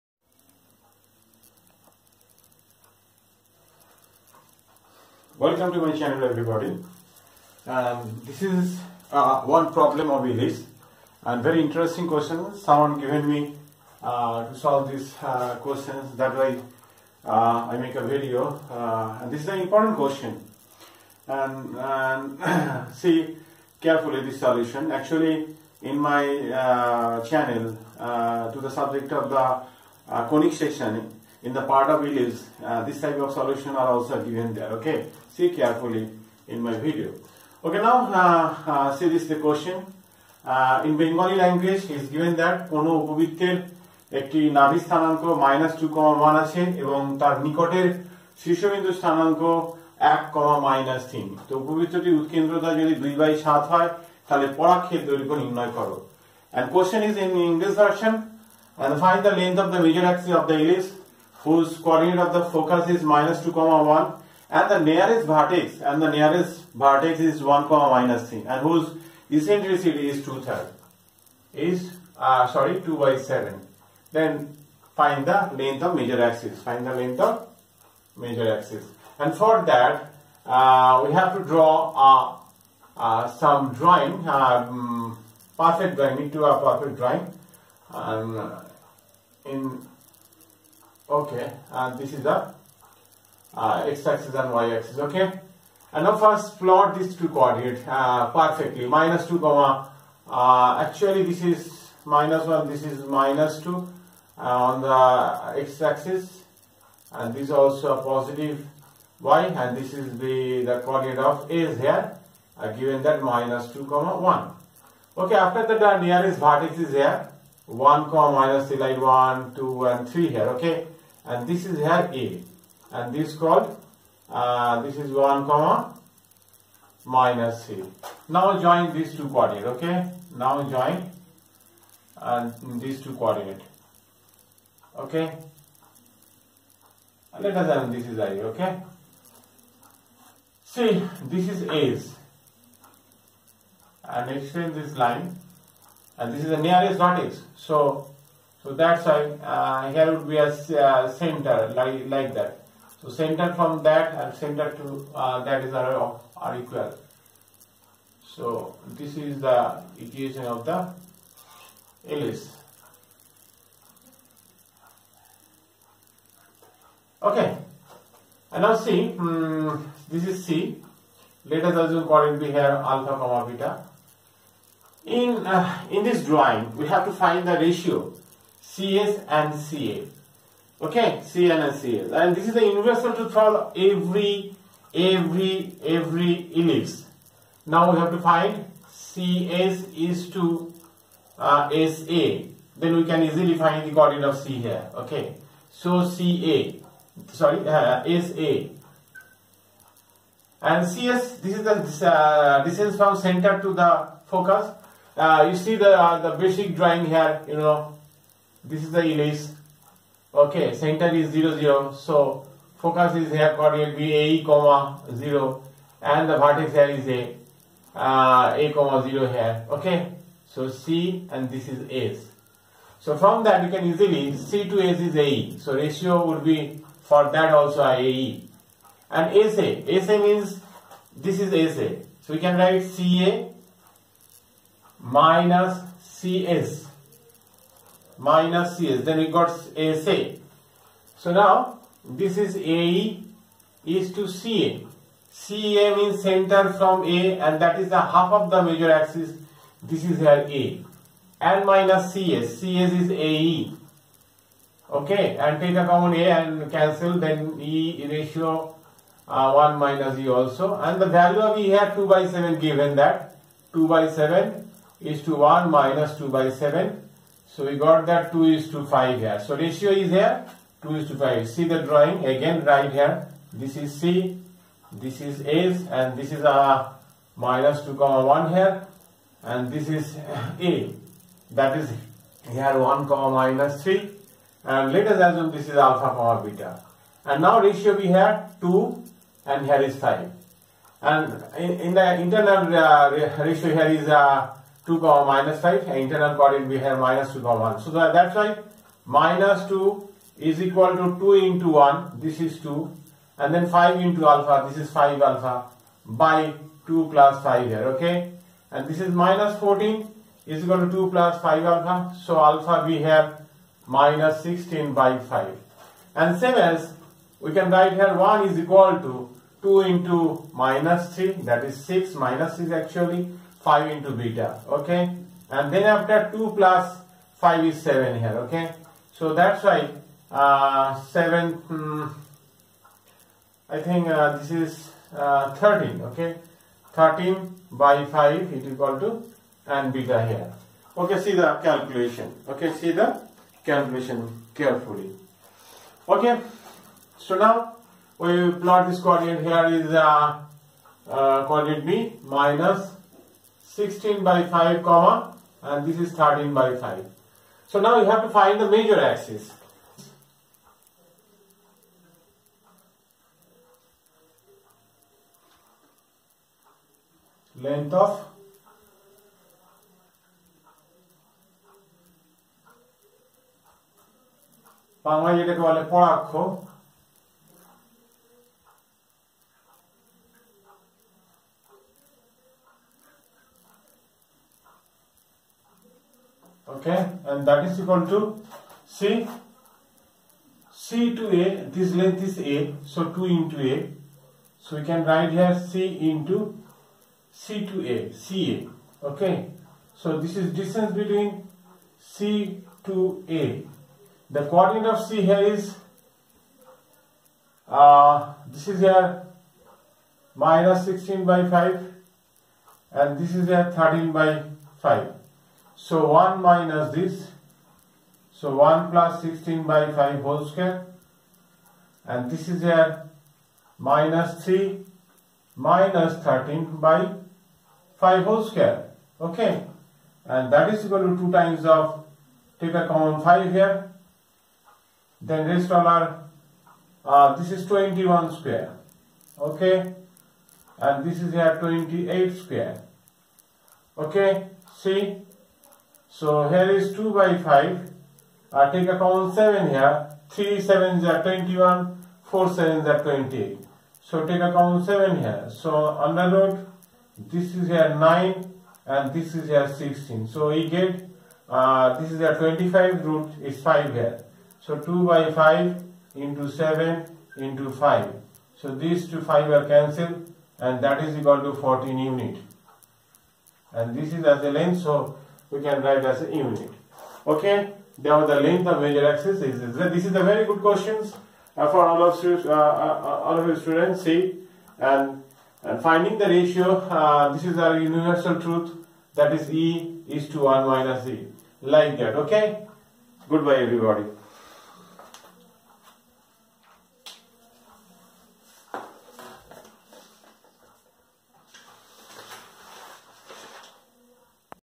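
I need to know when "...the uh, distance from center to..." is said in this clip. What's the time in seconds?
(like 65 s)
201 s.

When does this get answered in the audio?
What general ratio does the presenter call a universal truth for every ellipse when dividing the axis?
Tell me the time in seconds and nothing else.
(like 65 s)
489 s.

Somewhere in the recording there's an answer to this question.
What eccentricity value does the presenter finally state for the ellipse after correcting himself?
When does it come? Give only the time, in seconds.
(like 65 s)
72 s.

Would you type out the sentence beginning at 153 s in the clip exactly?
So center from that and center to uh, that is are, are equal.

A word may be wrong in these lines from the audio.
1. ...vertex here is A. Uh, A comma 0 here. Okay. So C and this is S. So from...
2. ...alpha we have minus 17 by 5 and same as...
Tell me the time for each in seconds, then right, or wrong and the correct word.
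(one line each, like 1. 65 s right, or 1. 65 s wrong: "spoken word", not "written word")
1. 216 s right
2. 312 s wrong: "16", not "17".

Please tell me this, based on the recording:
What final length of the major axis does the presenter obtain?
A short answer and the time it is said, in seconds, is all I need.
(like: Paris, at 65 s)
14 units, at 471 s.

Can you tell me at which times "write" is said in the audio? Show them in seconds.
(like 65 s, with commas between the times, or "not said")
232 s, 317 s, 395 s, 475 s.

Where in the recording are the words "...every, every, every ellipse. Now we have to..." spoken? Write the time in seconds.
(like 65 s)
183 s.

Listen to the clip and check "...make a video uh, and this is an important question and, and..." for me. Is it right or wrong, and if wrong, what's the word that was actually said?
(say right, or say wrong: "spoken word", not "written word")
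right.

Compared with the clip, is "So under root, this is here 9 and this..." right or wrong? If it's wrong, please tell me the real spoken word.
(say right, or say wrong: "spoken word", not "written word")
right.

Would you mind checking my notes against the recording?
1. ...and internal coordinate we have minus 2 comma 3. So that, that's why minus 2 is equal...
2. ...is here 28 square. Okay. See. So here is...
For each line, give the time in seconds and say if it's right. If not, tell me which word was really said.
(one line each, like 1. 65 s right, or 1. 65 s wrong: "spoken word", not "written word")
1. 295 s wrong: "1", not "3"
2. 441 s right.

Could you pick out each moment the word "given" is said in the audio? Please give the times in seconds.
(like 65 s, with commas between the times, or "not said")
12 s, 34 s, 42 s, 112 s, 262 s.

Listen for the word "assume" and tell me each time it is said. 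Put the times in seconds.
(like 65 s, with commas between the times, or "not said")
171 s, 285 s.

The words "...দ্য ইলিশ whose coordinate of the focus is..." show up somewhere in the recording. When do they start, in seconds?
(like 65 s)
60 s.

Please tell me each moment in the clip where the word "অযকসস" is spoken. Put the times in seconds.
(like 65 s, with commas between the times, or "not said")
60 s.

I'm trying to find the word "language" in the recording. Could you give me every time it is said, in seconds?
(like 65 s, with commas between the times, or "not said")
41 s.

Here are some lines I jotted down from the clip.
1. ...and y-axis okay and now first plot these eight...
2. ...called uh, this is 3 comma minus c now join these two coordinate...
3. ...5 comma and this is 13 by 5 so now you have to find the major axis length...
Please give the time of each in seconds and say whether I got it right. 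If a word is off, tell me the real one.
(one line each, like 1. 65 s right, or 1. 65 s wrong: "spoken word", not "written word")
1. 94 s wrong: "two", not "eight"
2. 123 s wrong: "1", not "3"
3. 354 s right.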